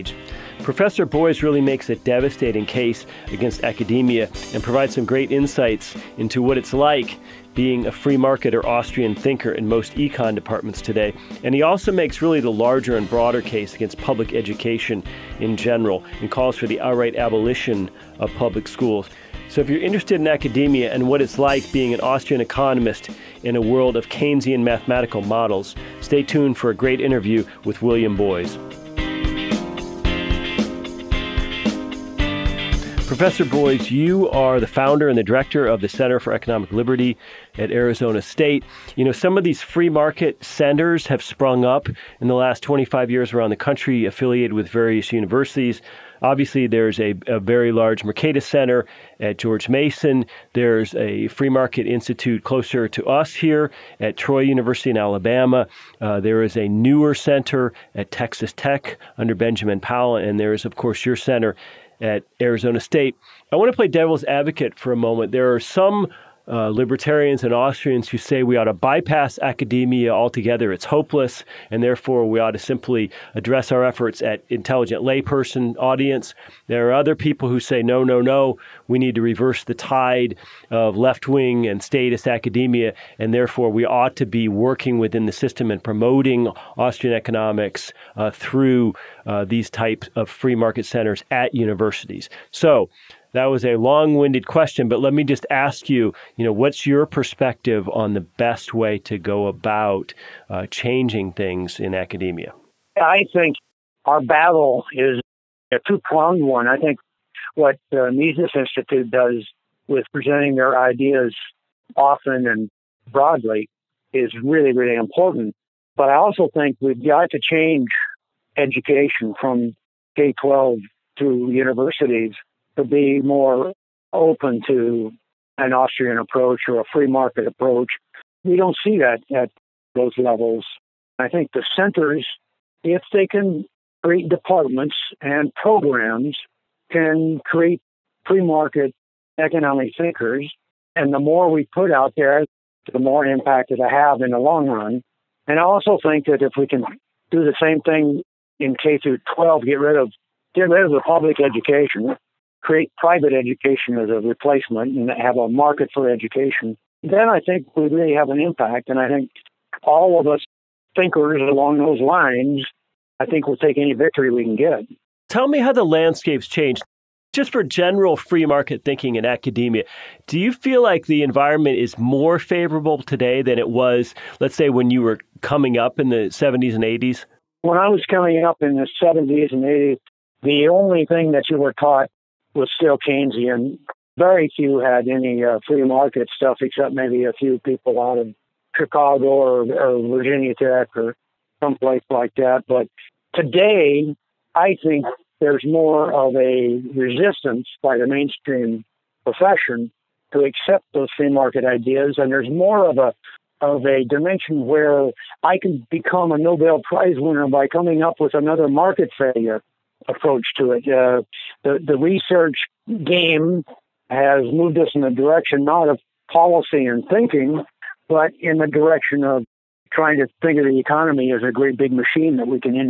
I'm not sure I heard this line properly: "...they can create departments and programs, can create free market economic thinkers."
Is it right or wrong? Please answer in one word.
right.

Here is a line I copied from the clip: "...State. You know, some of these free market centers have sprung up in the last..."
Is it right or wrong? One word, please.
right.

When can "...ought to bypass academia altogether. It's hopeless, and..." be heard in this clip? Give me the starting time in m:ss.
1:08.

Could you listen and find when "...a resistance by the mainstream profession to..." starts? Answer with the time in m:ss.
3:16.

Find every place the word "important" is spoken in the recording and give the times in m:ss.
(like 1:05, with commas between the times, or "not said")
1:54.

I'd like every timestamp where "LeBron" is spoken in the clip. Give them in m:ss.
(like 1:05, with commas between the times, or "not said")
not said.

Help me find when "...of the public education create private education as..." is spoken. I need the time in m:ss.
2:30.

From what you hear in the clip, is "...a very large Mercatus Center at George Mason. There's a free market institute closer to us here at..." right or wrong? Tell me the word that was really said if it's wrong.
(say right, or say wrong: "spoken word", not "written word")
right.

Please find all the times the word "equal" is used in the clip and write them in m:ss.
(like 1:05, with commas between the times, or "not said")
not said.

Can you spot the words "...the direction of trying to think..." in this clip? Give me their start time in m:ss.
3:38.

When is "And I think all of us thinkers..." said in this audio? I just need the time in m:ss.
2:38.